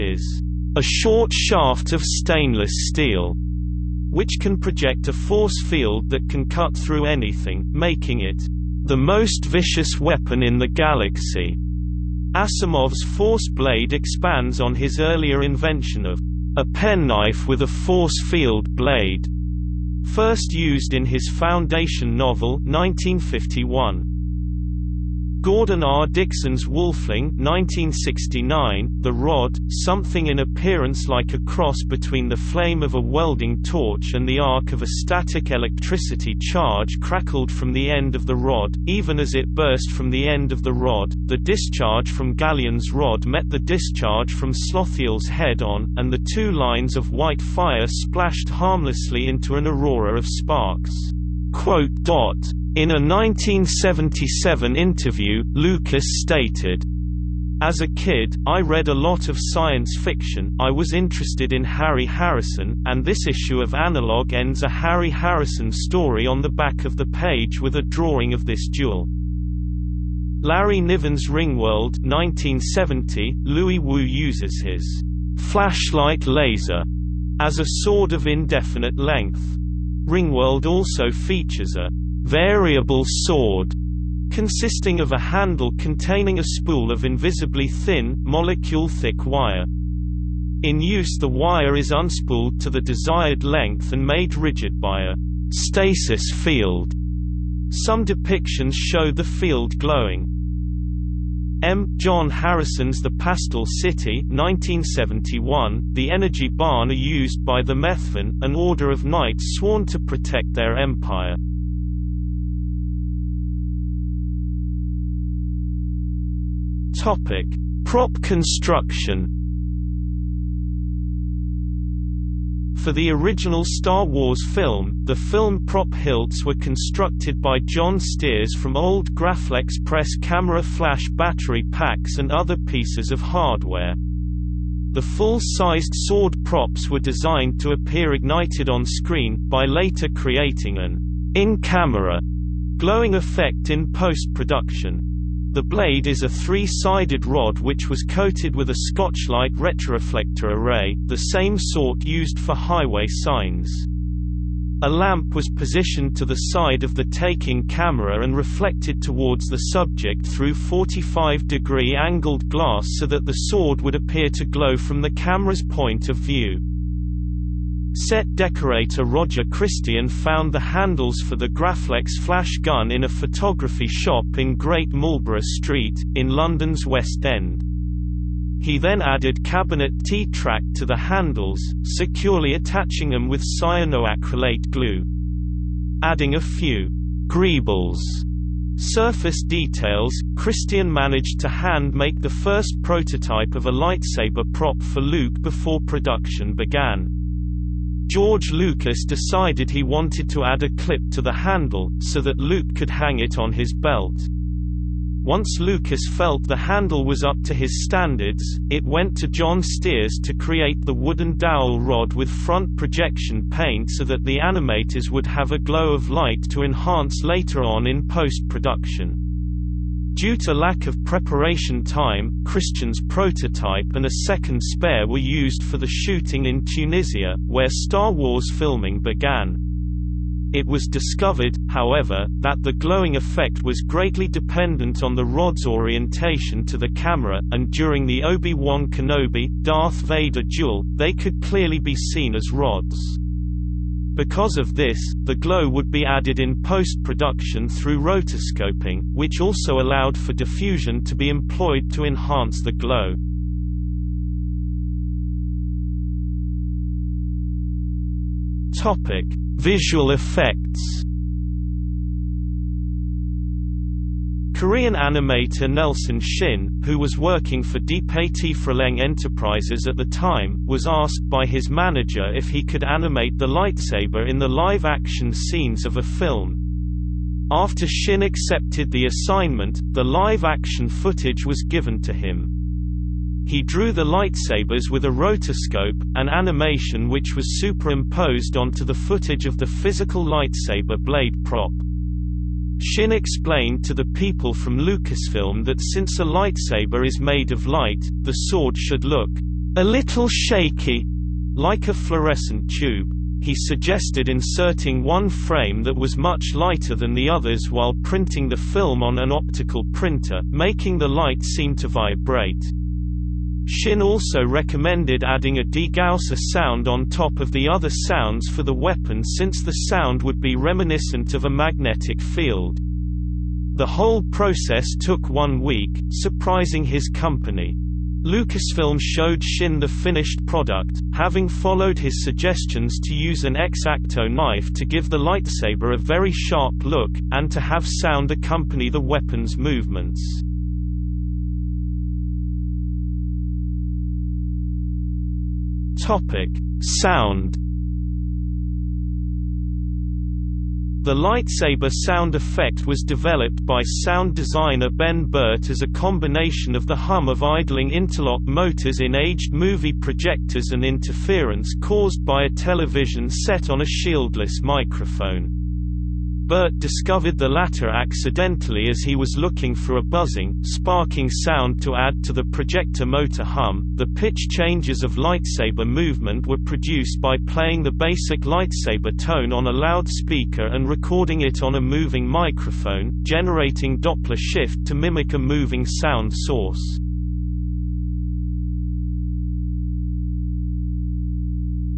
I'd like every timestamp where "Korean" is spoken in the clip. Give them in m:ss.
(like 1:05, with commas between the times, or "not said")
4:24.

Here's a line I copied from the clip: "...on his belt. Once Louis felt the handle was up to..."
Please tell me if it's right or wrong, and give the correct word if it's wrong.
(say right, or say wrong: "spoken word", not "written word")
wrong: "Lucas", not "Louis".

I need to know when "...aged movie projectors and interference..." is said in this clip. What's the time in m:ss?
5:59.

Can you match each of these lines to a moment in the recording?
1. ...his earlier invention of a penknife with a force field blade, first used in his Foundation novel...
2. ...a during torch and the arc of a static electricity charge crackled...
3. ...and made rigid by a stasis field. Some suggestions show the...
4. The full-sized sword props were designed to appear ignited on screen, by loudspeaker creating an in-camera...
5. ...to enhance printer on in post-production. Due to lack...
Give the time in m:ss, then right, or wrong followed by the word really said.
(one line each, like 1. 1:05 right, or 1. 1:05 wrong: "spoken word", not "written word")
1. 0:14 right
2. 0:32 wrong: "welding", not "during"
3. 1:33 wrong: "depictions", not "suggestions"
4. 2:14 wrong: "later", not "loudspeaker"
5. 3:36 wrong: "later", not "printer".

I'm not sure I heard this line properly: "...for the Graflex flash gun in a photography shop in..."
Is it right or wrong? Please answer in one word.
right.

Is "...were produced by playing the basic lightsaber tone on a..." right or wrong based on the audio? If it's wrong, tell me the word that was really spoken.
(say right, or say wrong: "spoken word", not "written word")
right.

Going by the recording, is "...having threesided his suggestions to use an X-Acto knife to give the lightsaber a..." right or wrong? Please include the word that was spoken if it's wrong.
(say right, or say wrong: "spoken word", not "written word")
wrong: "followed", not "threesided".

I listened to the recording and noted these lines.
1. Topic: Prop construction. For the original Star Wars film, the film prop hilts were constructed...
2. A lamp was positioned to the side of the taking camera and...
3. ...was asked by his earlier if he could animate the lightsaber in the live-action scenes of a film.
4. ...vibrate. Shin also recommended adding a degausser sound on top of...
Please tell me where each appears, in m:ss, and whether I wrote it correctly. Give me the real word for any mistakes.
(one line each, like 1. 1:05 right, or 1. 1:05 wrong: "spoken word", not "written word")
1. 1:56 right
2. 2:34 right
3. 4:30 wrong: "manager", not "earlier"
4. 5:11 right.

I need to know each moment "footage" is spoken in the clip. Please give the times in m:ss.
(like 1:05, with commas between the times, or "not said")
4:40, 4:48.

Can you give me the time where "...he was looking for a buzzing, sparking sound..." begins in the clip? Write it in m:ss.
6:09.